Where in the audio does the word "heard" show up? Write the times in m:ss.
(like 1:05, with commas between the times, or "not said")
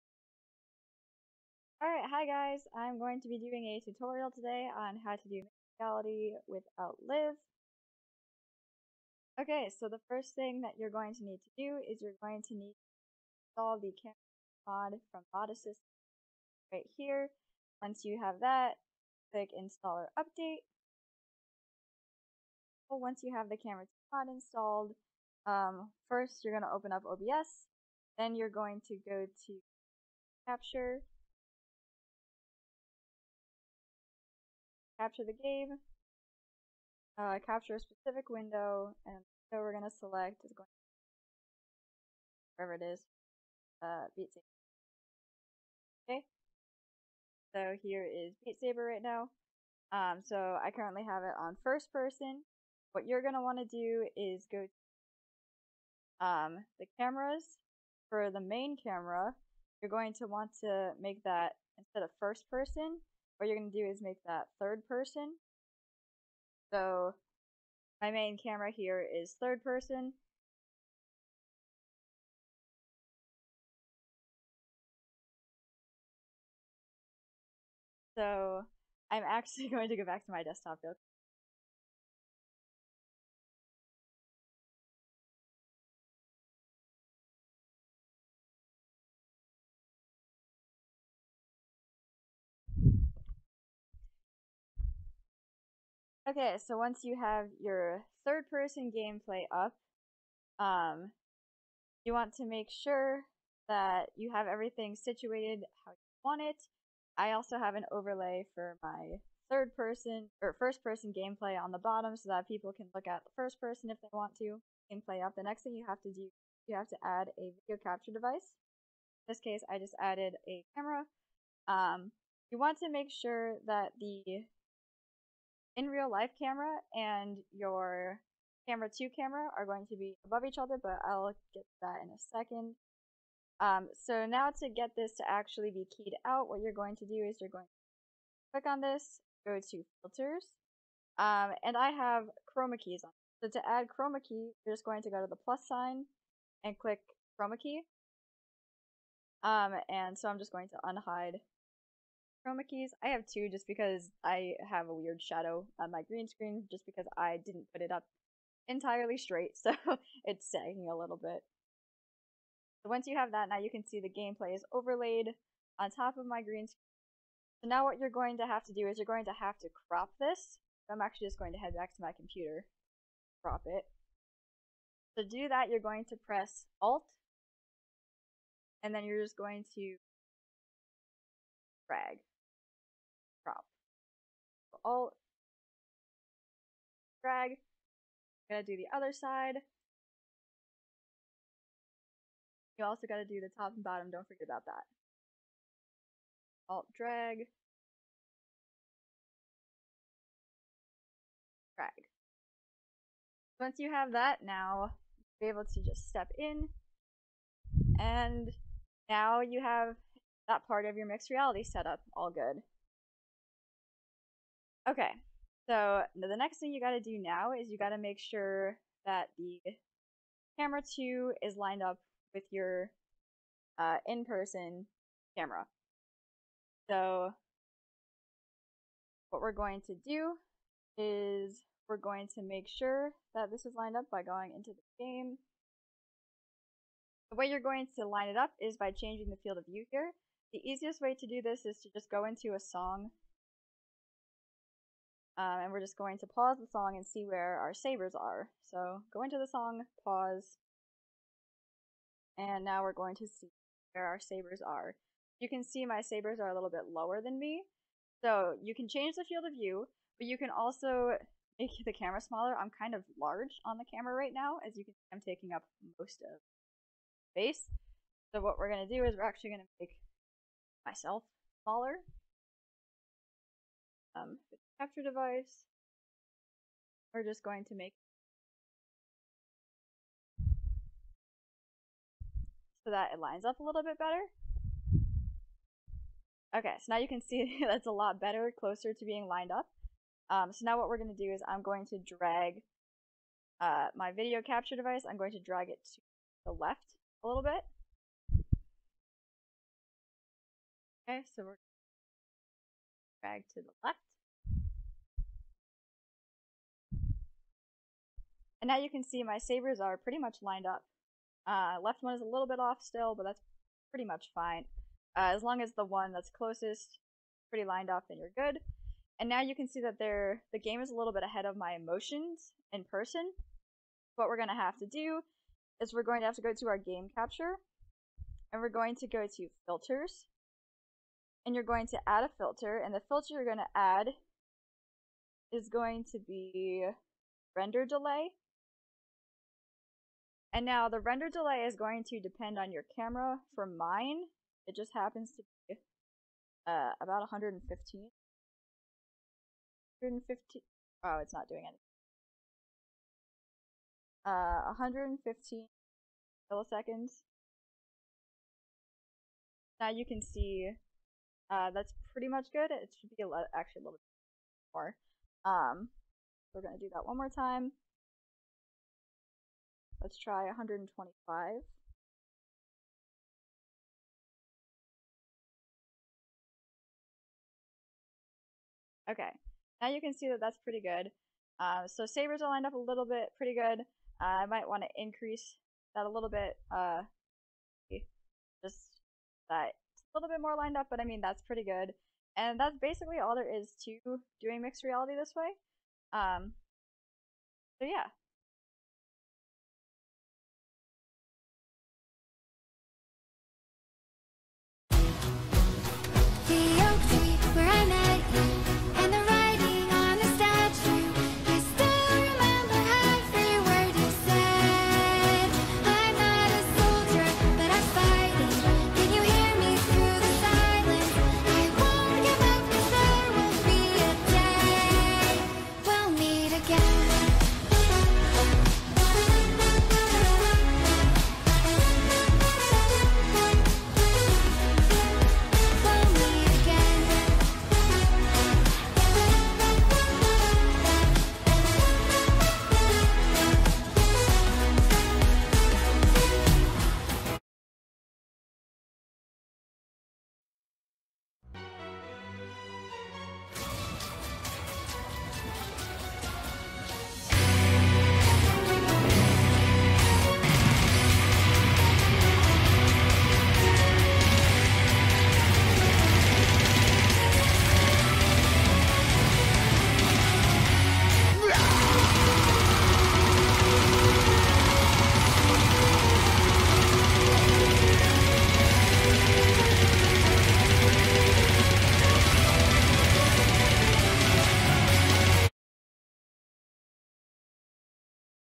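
not said.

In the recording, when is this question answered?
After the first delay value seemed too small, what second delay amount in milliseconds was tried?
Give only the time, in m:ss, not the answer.
6:10.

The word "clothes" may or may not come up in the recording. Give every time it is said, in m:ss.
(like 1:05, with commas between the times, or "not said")
not said.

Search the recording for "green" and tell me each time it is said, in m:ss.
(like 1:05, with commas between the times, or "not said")
2:36, 2:46.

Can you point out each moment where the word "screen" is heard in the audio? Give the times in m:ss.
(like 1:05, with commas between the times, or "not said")
2:36, 2:46.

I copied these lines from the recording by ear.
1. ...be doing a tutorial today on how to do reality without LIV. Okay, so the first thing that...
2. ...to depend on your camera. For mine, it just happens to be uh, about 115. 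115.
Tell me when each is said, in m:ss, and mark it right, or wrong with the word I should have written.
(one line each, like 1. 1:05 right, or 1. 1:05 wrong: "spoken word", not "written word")
1. 0:03 right
2. 5:42 right.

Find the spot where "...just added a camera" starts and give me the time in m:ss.
1:59.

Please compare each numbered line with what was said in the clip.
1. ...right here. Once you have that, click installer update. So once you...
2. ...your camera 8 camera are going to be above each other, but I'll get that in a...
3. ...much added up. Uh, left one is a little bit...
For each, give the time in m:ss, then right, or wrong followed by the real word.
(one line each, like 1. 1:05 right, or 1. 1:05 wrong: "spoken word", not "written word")
1. 0:16 right
2. 2:07 wrong: "2", not "8"
3. 5:10 wrong: "lined", not "added".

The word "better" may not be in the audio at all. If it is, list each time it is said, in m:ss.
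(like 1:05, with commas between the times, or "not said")
4:43, 4:48.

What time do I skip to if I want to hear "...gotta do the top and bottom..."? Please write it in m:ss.
3:13.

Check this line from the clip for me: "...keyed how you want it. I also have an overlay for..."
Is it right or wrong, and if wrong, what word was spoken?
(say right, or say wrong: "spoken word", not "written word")
wrong: "situated", not "keyed".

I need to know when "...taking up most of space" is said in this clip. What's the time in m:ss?
4:25.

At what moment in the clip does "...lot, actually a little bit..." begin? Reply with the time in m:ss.
6:03.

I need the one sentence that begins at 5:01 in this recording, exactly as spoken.
Okay, so we're drag to the left.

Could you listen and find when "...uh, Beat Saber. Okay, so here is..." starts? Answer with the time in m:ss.
0:43.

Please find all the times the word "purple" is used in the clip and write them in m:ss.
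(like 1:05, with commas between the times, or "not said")
not said.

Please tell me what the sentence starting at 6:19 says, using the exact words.
Okay, now you can see that that's pretty good.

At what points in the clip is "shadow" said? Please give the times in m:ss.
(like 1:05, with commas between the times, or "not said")
2:35.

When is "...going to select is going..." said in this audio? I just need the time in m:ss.
0:39.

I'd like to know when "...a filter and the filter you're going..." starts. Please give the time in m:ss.
5:32.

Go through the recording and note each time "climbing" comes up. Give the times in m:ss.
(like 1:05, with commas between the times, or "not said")
not said.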